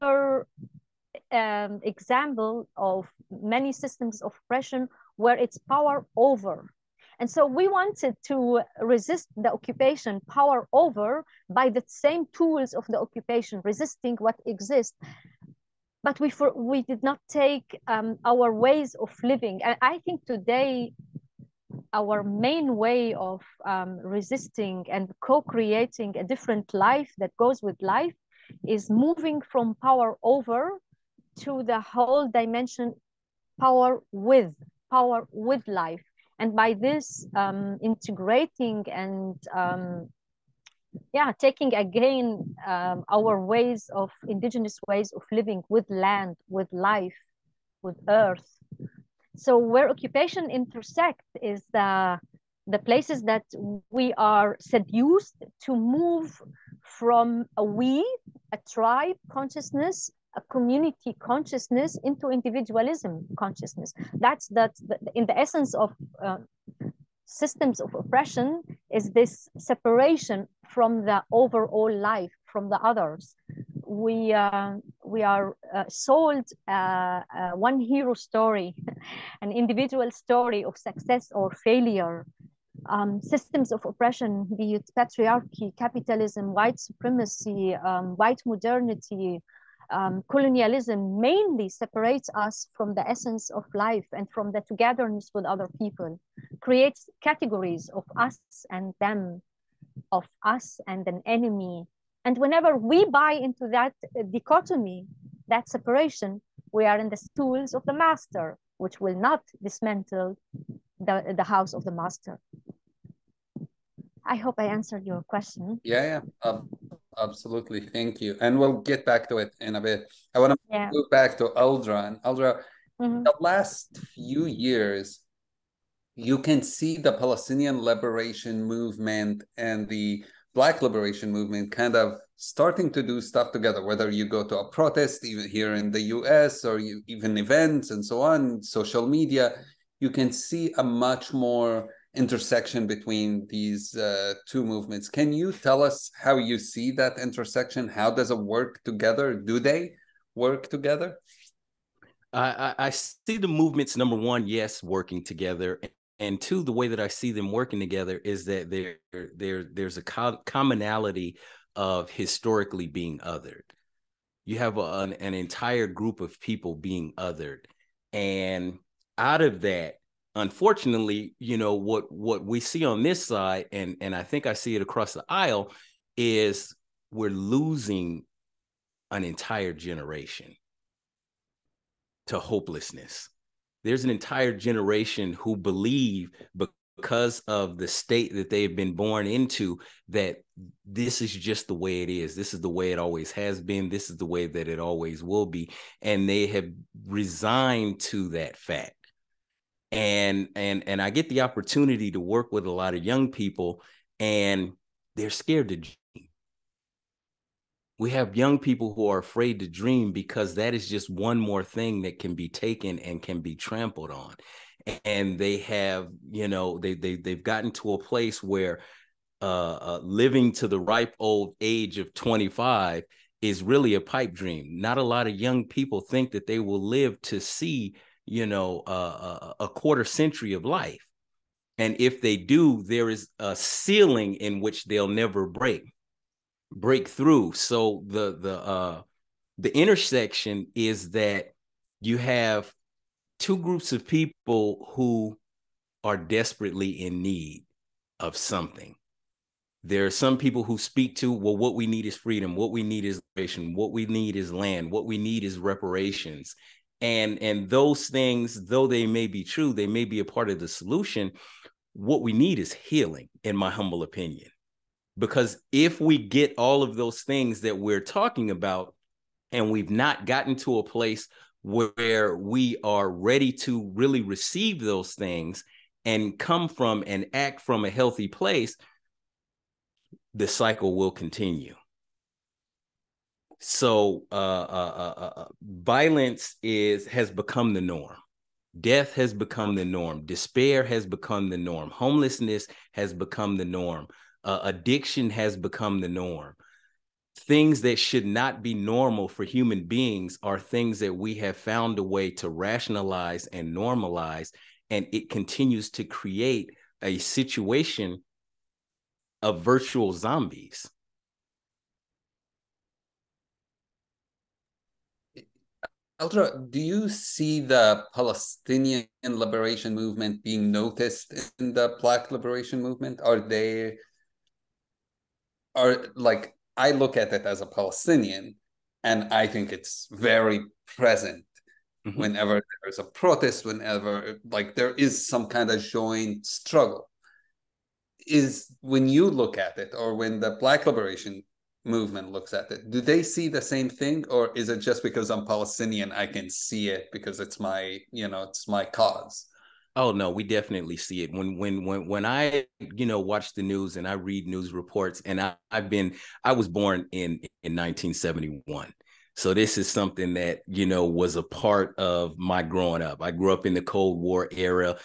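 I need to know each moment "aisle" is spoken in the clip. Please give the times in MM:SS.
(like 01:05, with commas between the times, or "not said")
02:55.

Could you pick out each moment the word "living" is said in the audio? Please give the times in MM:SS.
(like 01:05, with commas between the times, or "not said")
00:19, 00:45, 03:40.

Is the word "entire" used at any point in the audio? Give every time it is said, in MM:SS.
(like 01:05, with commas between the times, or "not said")
02:45, 02:59, 03:04.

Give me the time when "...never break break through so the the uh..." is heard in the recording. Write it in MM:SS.
03:55.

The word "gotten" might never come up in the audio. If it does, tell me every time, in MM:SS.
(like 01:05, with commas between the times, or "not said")
03:37, 04:30.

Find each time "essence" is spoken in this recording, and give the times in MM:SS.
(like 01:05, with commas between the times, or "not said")
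01:05, 01:33.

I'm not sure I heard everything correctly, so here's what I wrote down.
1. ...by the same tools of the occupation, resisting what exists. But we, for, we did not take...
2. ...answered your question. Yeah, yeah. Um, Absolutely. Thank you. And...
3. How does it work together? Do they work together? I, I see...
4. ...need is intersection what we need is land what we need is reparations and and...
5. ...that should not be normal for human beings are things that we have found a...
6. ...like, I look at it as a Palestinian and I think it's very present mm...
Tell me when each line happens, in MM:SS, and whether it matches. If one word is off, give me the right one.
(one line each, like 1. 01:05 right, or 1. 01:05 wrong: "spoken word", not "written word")
1. 00:11 right
2. 01:54 right
3. 02:27 right
4. 04:12 wrong: "liberation", not "intersection"
5. 04:57 right
6. 05:26 right.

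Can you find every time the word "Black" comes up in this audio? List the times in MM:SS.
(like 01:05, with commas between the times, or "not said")
02:10, 05:22, 05:40.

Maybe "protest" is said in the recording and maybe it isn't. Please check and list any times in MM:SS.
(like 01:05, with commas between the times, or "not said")
02:14, 05:33.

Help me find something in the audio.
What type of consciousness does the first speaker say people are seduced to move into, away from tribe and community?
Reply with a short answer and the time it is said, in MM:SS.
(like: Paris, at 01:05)
individualism consciousness, at 01:02.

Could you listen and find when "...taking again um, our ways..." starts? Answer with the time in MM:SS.
00:41.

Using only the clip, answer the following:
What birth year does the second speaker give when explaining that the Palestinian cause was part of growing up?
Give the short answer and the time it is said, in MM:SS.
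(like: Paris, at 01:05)
1971, at 05:57.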